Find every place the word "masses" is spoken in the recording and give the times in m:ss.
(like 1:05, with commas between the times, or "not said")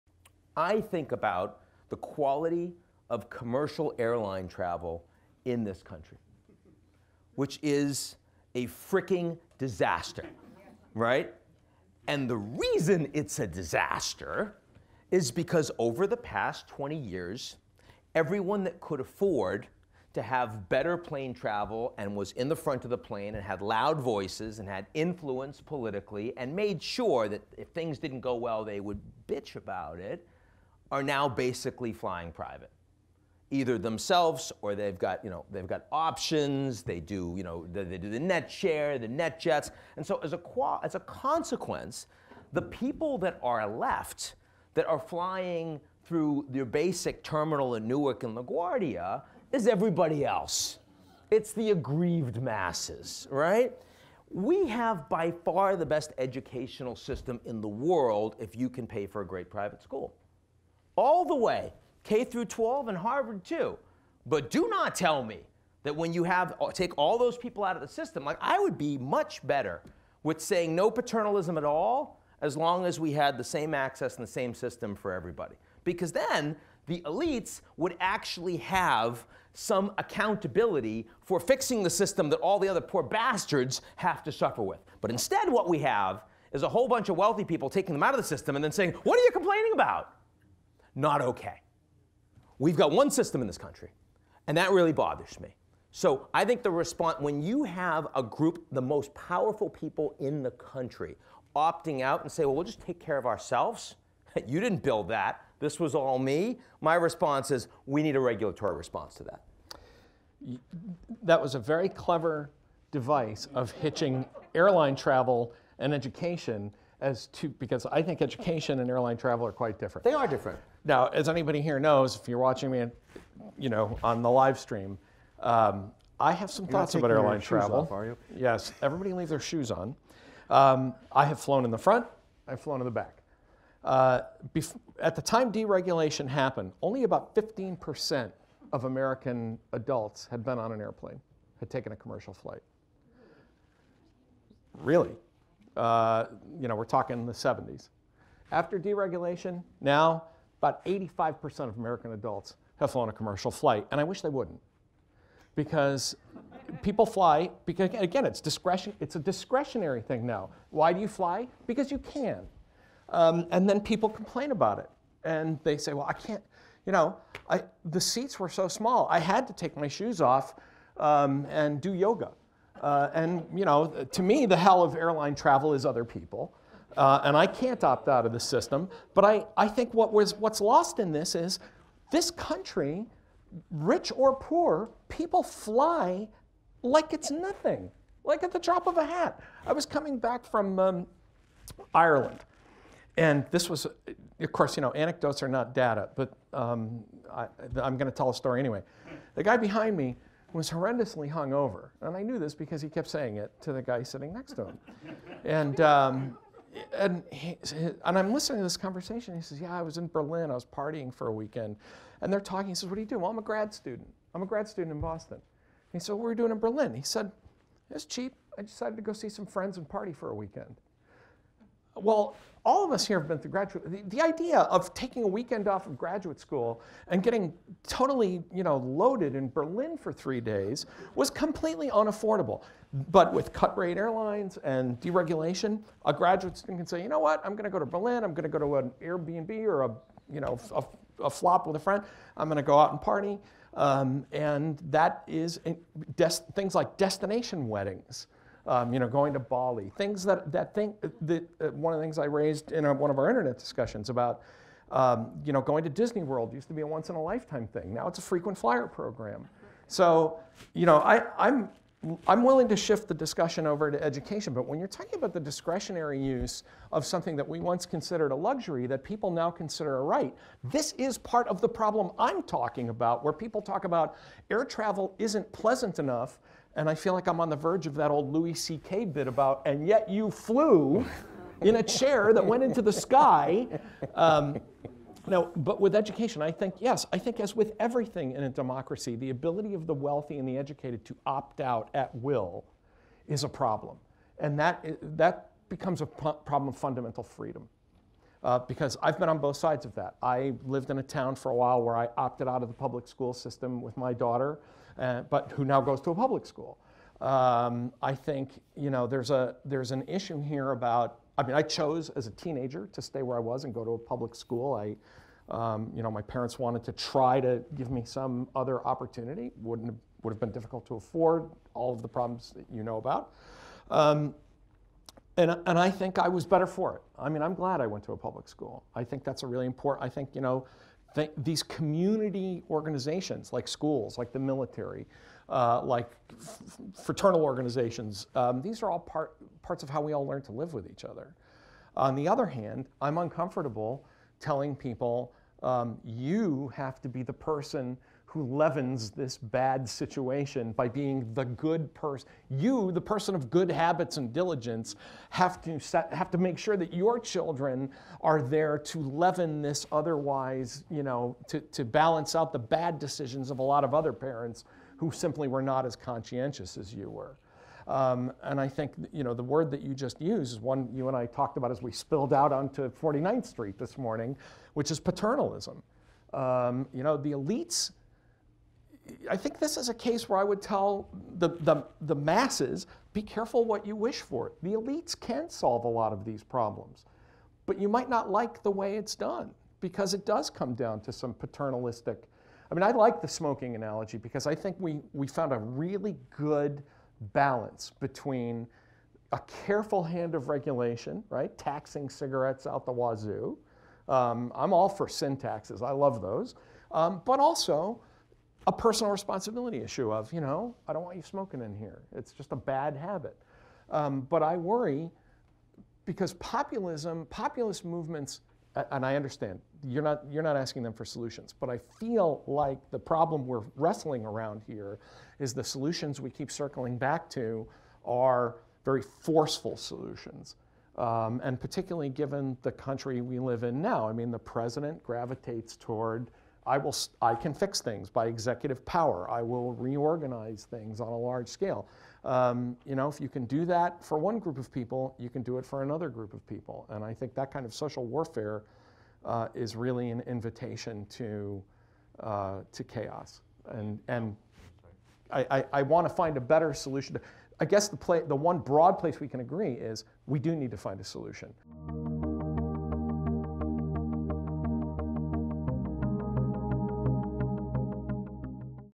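0:52, 6:22.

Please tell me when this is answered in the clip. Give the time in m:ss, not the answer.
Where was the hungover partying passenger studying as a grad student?
3:35.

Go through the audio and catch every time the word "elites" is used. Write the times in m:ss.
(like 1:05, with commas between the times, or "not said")
1:17, 6:17, 6:24.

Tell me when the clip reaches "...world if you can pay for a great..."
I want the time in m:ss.
0:57.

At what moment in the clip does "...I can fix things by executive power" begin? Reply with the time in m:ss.
7:17.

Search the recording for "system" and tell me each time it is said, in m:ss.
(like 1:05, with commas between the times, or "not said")
0:56, 1:07, 1:14, 1:21, 1:28, 1:33, 2:58, 5:03.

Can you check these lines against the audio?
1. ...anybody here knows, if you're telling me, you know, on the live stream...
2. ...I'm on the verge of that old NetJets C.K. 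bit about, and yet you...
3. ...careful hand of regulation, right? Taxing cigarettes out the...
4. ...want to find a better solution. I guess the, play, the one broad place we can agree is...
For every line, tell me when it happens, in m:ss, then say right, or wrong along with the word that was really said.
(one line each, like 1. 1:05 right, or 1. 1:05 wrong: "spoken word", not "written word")
1. 2:01 wrong: "watching", not "telling"
2. 4:37 wrong: "Louis", not "NetJets"
3. 6:39 right
4. 7:35 right.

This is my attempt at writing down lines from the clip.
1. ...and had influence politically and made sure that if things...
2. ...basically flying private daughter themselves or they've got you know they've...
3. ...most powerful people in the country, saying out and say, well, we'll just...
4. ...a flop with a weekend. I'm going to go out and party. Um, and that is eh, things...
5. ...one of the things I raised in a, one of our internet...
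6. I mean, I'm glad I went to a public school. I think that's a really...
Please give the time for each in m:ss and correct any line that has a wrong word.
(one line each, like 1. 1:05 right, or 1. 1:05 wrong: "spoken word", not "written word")
1. 0:24 right
2. 0:31 wrong: "either", not "daughter"
3. 1:38 wrong: "opting", not "saying"
4. 4:01 wrong: "friend", not "weekend"
5. 4:11 right
6. 5:27 right.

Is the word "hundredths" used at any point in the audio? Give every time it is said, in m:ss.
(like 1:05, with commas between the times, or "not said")
not said.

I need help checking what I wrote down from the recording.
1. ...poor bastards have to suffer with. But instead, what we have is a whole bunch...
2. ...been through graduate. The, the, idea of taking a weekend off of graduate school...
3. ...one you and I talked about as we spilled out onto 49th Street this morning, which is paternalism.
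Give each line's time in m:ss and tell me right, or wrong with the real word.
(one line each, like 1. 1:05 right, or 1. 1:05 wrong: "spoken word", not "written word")
1. 1:22 right
2. 3:43 right
3. 6:10 right.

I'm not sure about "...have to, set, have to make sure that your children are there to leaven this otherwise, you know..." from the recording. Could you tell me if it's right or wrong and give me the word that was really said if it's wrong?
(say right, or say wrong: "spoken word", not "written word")
right.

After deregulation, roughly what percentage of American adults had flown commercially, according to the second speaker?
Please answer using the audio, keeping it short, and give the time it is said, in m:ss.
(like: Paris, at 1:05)
85%, at 2:30.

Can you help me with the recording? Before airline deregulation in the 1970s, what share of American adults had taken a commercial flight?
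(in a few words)
15%.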